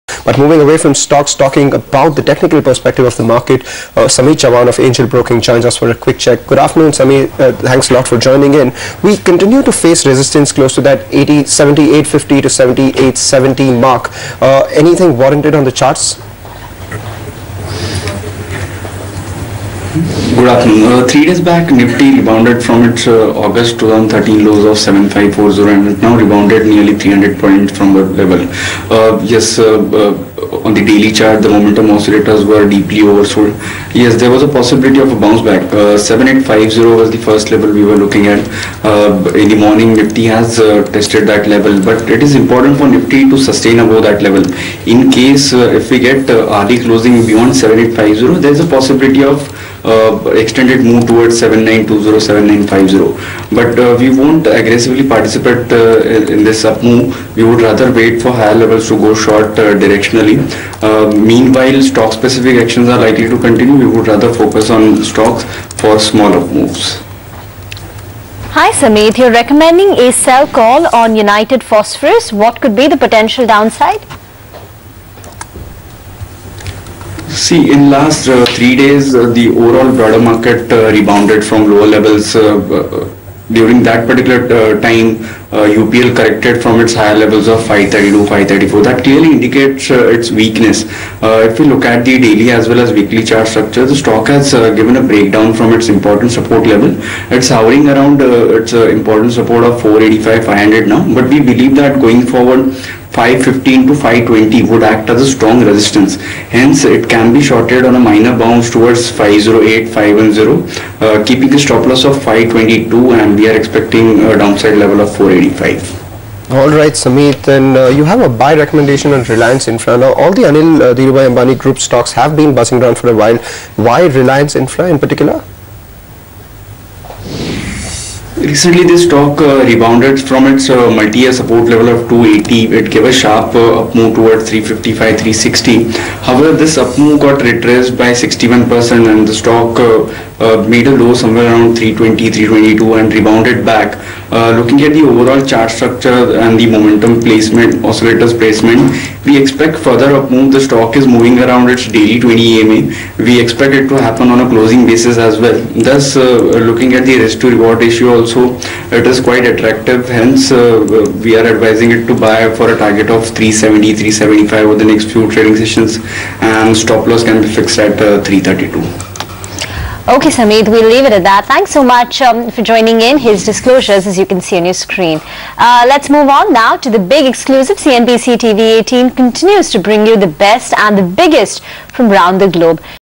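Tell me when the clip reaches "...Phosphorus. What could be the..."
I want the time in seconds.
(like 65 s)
71 s.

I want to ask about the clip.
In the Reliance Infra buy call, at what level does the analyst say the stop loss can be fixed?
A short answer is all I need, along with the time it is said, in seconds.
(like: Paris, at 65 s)
332, at 168 s.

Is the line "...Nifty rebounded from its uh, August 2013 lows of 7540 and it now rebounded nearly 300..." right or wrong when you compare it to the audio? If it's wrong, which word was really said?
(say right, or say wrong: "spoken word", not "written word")
right.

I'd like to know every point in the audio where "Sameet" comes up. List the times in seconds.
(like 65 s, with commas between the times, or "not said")
6 s, 68 s, 117 s, 170 s.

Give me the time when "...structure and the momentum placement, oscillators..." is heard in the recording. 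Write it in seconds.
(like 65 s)
145 s.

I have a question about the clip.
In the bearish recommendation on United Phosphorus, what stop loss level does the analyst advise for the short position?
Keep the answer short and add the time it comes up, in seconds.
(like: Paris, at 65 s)
522, at 112 s.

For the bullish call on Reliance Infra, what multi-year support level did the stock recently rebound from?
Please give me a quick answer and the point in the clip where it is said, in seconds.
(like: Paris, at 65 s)
280, at 132 s.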